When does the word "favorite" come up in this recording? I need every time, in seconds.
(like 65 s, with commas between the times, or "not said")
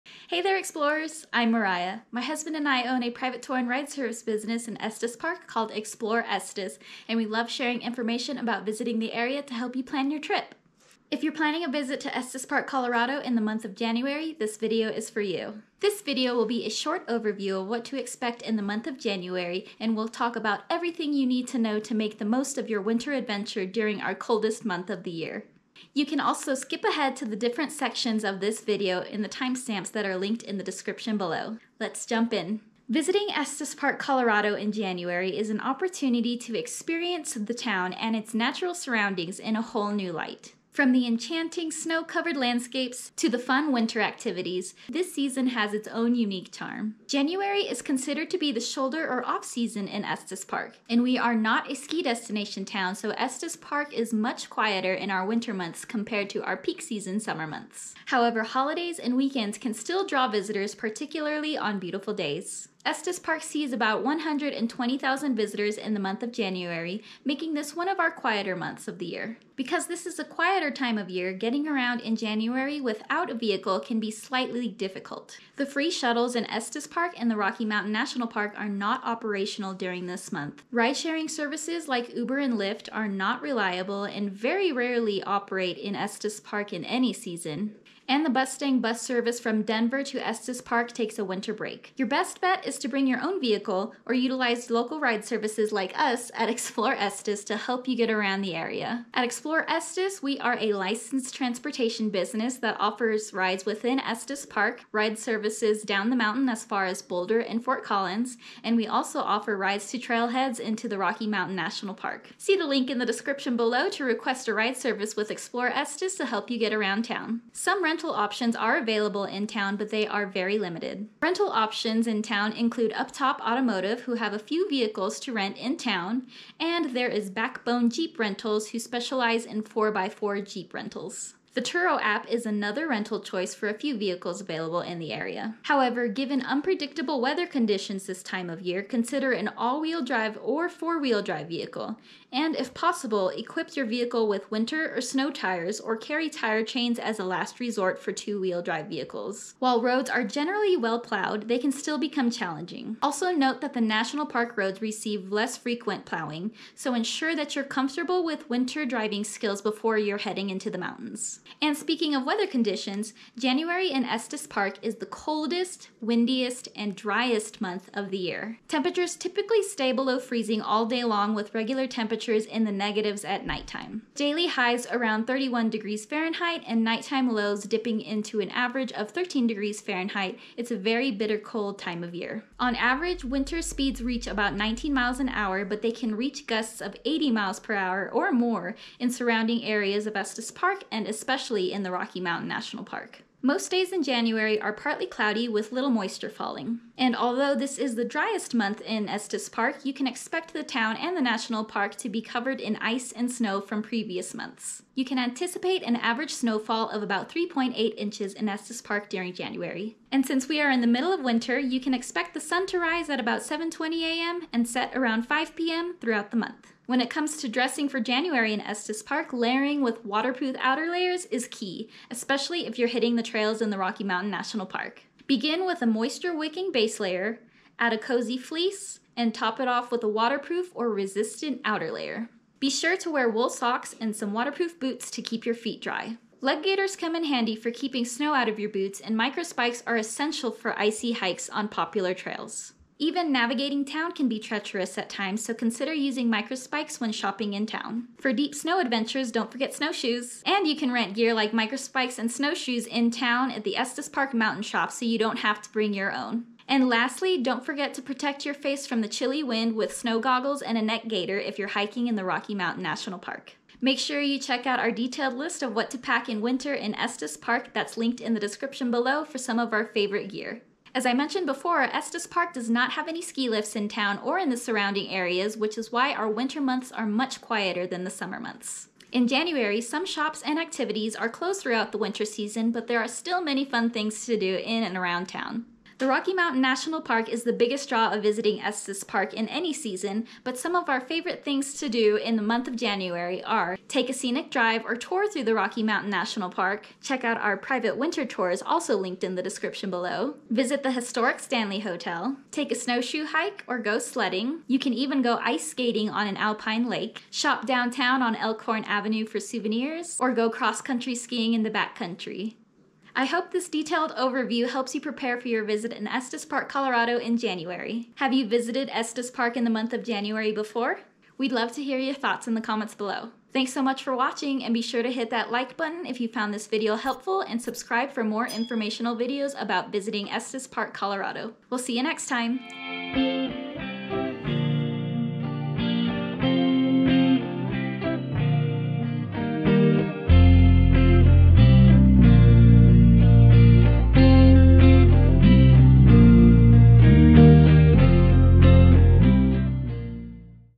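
269 s, 290 s.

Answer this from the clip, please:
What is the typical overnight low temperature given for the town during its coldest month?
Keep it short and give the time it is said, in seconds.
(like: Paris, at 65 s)
13 degrees Fahrenheit, at 179 s.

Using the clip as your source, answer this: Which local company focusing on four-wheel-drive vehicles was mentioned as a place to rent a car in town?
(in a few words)
Backbone Jeep Rentals.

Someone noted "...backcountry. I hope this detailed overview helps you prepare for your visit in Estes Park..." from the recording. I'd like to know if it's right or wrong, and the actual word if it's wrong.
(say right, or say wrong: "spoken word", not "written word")
right.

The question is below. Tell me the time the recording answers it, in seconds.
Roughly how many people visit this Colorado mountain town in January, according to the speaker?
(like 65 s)
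64 s.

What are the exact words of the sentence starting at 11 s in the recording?
If you're planning a visit to Estes Park, Colorado in the month of January, this video is for you.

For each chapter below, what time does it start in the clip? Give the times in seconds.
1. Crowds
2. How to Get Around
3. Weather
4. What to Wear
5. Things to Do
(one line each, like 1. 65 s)
1. 46 s
2. 69 s
3. 161 s
4. 216 s
5. 270 s.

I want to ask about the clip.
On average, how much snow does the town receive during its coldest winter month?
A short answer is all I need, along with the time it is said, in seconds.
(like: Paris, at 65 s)
3.8 inches, at 207 s.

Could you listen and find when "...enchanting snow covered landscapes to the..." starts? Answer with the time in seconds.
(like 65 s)
41 s.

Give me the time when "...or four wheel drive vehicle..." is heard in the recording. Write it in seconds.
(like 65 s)
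140 s.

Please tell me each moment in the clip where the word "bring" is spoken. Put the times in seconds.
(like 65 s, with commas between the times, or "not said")
92 s, 255 s.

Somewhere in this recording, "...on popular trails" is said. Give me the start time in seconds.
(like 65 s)
241 s.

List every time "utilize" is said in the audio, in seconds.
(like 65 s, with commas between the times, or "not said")
94 s.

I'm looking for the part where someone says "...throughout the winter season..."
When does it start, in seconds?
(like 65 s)
281 s.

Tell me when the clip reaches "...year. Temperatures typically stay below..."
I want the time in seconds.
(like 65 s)
168 s.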